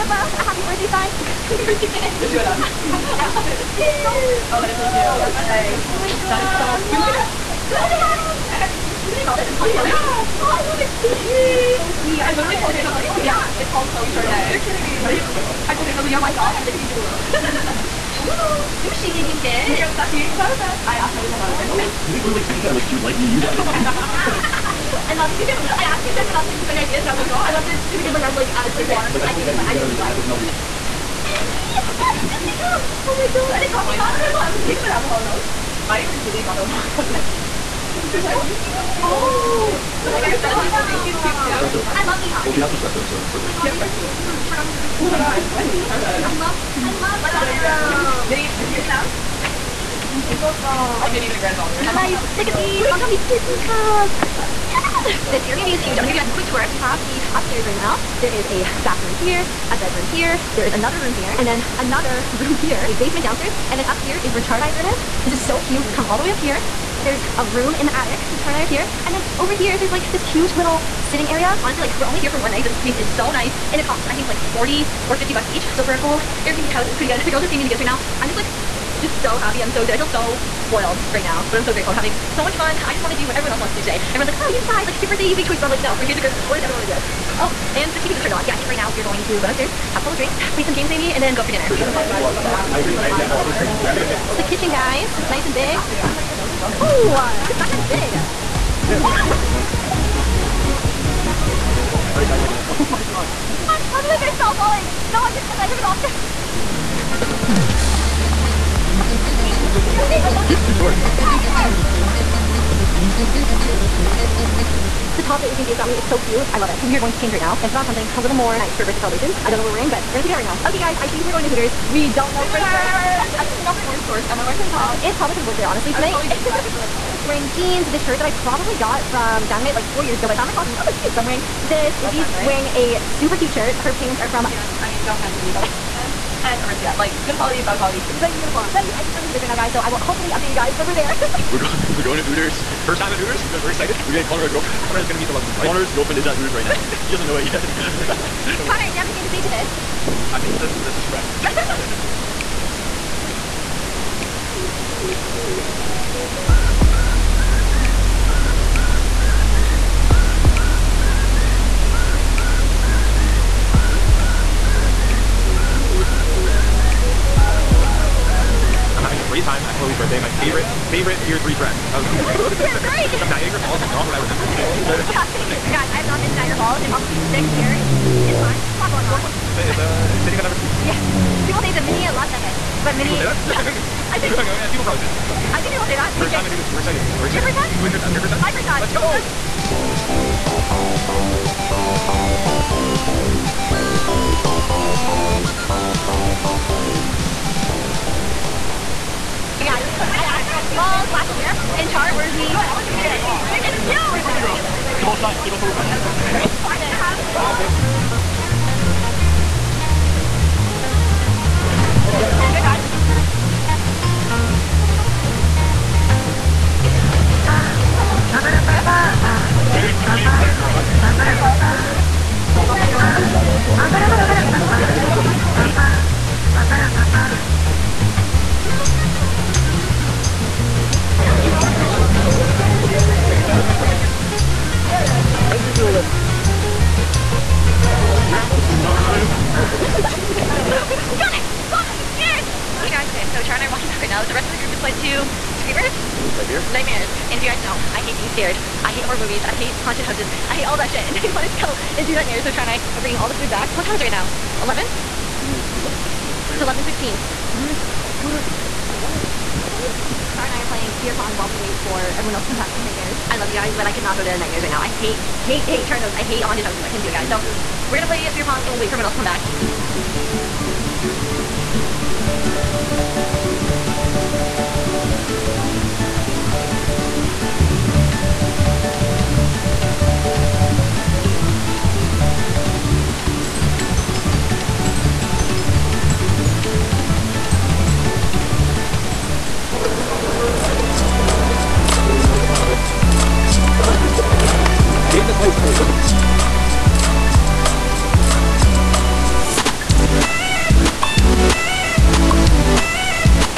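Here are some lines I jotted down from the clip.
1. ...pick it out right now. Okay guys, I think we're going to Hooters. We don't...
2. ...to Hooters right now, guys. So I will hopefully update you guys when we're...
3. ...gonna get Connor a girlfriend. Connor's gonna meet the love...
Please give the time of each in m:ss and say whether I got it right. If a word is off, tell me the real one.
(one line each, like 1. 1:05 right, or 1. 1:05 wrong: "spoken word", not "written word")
1. 2:00 right
2. 2:19 right
3. 2:24 right.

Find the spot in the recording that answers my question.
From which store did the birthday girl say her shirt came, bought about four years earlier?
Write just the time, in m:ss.
2:09.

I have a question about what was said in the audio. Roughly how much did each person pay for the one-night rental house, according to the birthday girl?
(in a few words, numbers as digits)
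40 or 50 bucks.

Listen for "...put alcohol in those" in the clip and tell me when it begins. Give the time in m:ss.
0:34.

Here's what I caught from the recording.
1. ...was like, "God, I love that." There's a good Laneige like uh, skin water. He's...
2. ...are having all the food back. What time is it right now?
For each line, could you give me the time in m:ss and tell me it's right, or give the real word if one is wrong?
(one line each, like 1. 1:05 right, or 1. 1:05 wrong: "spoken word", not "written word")
1. 0:27 right
2. 4:12 wrong: "bringing", not "having".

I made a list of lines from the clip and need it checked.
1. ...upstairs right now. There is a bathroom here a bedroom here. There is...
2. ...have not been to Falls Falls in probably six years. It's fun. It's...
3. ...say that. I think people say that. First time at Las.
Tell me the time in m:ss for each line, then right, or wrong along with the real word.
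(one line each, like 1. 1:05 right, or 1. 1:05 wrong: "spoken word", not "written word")
1. 0:57 right
2. 2:56 wrong: "Niagara", not "Falls"
3. 3:05 wrong: "Hooters", not "Las".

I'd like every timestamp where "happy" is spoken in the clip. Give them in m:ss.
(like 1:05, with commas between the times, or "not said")
0:00, 1:19.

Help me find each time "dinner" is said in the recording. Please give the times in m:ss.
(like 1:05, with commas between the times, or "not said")
1:31.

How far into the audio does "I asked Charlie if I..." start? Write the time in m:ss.
0:20.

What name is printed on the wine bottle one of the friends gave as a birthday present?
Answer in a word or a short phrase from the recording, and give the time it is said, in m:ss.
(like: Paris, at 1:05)
Chloe Chardonnay, at 0:13.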